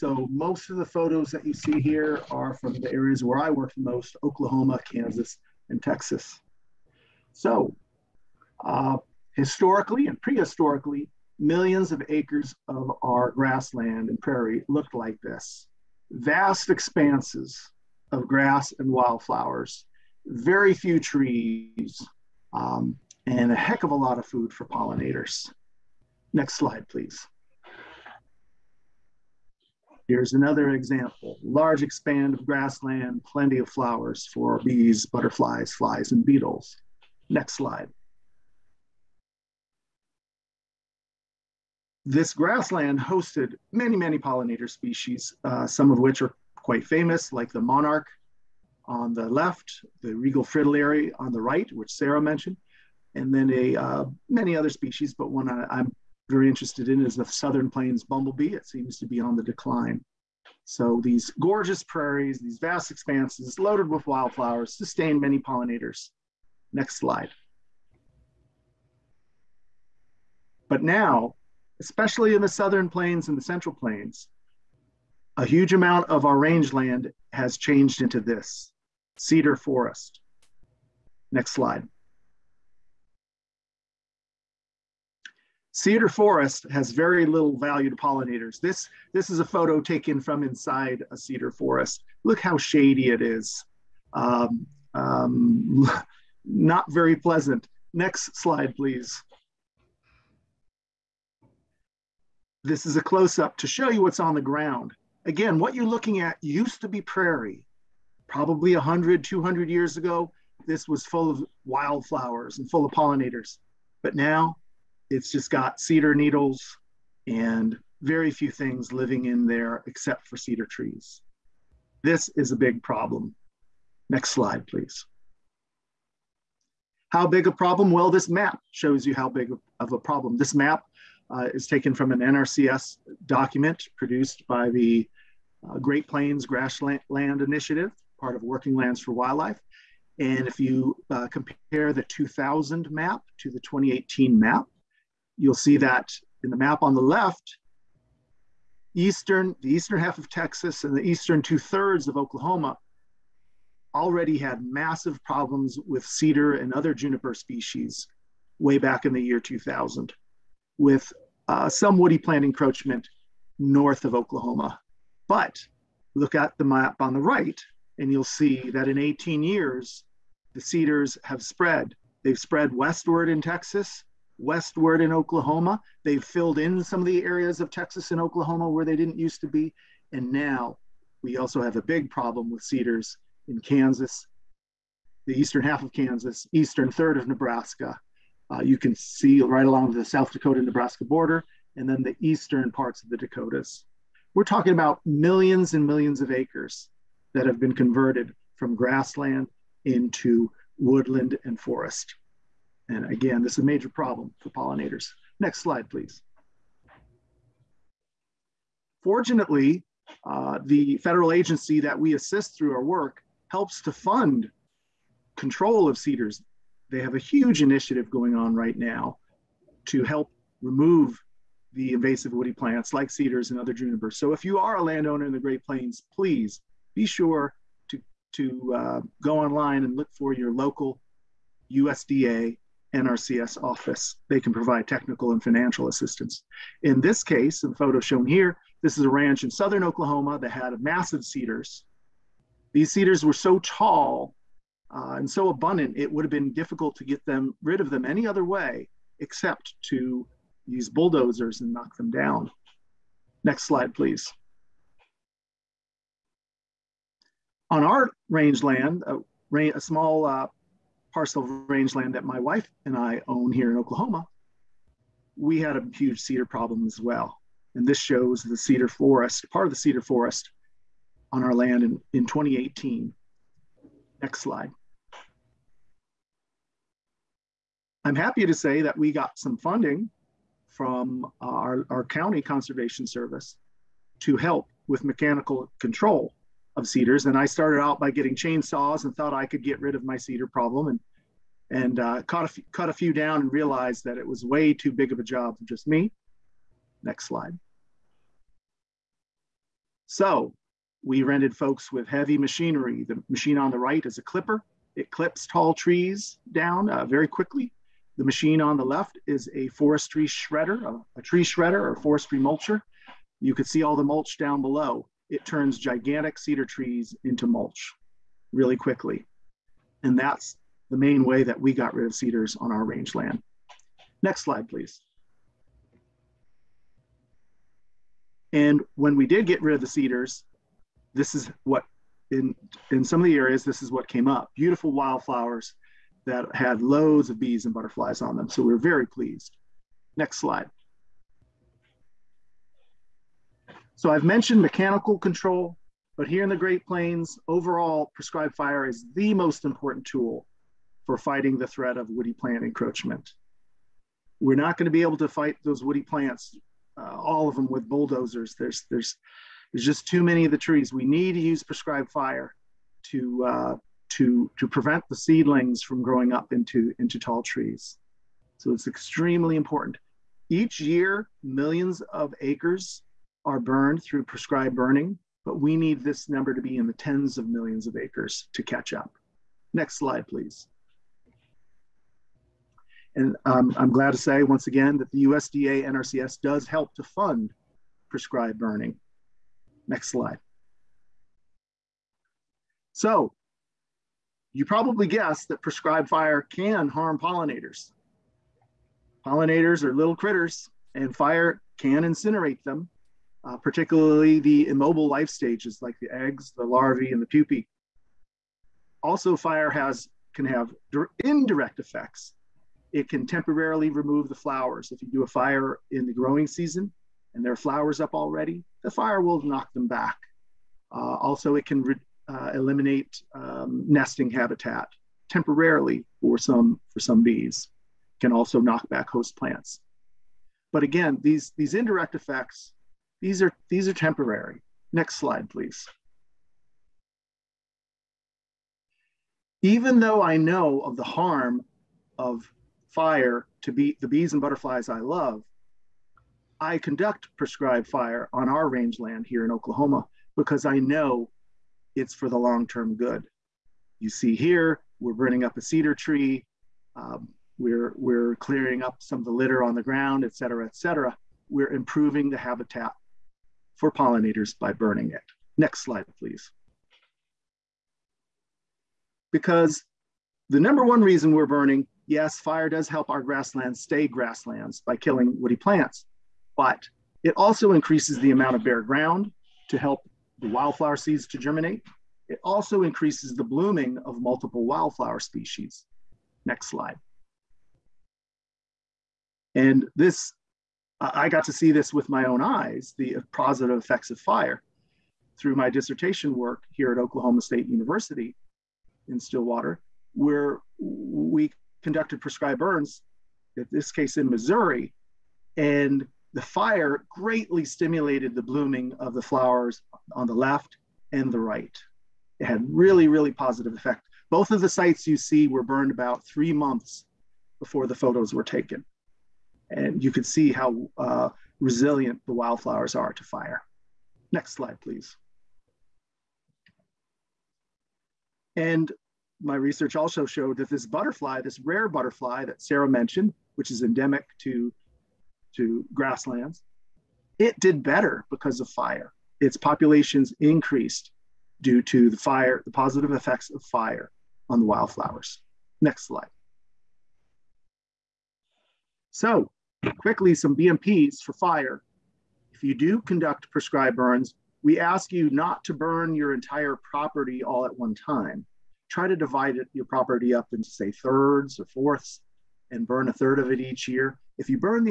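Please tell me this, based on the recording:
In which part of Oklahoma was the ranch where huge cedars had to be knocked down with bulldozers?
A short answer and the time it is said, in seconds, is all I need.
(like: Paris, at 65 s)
Southern Oklahoma, at 239 s.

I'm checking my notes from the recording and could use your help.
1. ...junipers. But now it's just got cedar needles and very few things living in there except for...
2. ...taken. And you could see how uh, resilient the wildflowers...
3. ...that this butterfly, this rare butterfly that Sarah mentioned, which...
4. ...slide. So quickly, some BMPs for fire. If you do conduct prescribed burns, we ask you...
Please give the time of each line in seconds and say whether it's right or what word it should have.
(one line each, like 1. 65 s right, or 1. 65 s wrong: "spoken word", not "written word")
1. 112 s wrong: "pollinators", not "junipers"
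2. 518 s right
3. 530 s right
4. 546 s right.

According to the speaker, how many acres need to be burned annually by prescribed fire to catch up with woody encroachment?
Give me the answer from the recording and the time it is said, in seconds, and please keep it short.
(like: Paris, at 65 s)
Tens of millions, at 376 s.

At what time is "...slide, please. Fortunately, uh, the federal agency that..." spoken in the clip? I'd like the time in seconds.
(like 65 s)
205 s.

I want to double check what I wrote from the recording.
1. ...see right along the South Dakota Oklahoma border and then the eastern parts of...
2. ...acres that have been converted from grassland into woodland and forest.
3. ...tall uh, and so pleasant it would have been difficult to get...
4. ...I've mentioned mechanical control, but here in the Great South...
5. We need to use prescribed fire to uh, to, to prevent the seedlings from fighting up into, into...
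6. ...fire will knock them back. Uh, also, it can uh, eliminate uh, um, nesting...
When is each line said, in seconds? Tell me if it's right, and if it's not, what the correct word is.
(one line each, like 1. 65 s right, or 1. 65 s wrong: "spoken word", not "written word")
1. 188 s wrong: "Nebraska", not "Oklahoma"
2. 196 s right
3. 243 s wrong: "abundant", not "pleasant"
4. 344 s wrong: "Plains", not "South"
5. 360 s wrong: "growing", not "fighting"
6. 418 s right.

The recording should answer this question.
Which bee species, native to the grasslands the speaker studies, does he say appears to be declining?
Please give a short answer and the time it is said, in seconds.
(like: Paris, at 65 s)
Southern plains bumblebee, at 57 s.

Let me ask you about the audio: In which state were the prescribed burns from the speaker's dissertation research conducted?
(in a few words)
Missouri.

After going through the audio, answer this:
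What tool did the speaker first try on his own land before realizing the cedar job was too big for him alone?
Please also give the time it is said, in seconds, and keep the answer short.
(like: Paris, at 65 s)
Chainsaws, at 288 s.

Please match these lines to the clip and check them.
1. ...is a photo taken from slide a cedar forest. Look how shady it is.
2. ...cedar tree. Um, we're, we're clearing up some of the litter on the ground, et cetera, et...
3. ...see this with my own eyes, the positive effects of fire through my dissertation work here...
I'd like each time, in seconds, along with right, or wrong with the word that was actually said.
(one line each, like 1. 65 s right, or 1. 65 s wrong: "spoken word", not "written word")
1. 89 s wrong: "inside", not "slide"
2. 455 s right
3. 491 s right.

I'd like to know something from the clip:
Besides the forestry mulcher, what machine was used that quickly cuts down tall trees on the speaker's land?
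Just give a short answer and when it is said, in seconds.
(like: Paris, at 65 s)
Clipper, at 304 s.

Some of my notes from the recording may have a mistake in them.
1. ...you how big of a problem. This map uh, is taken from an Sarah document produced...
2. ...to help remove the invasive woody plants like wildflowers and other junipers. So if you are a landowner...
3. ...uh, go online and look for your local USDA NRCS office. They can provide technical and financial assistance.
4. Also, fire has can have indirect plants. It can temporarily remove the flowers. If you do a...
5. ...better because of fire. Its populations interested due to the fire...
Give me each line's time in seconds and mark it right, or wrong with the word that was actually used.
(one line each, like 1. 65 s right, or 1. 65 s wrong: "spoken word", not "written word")
1. 129 s wrong: "NRCS", not "Sarah"
2. 219 s wrong: "cedars", not "wildflowers"
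3. 228 s right
4. 409 s wrong: "effects", not "plants"
5. 537 s wrong: "increased", not "interested".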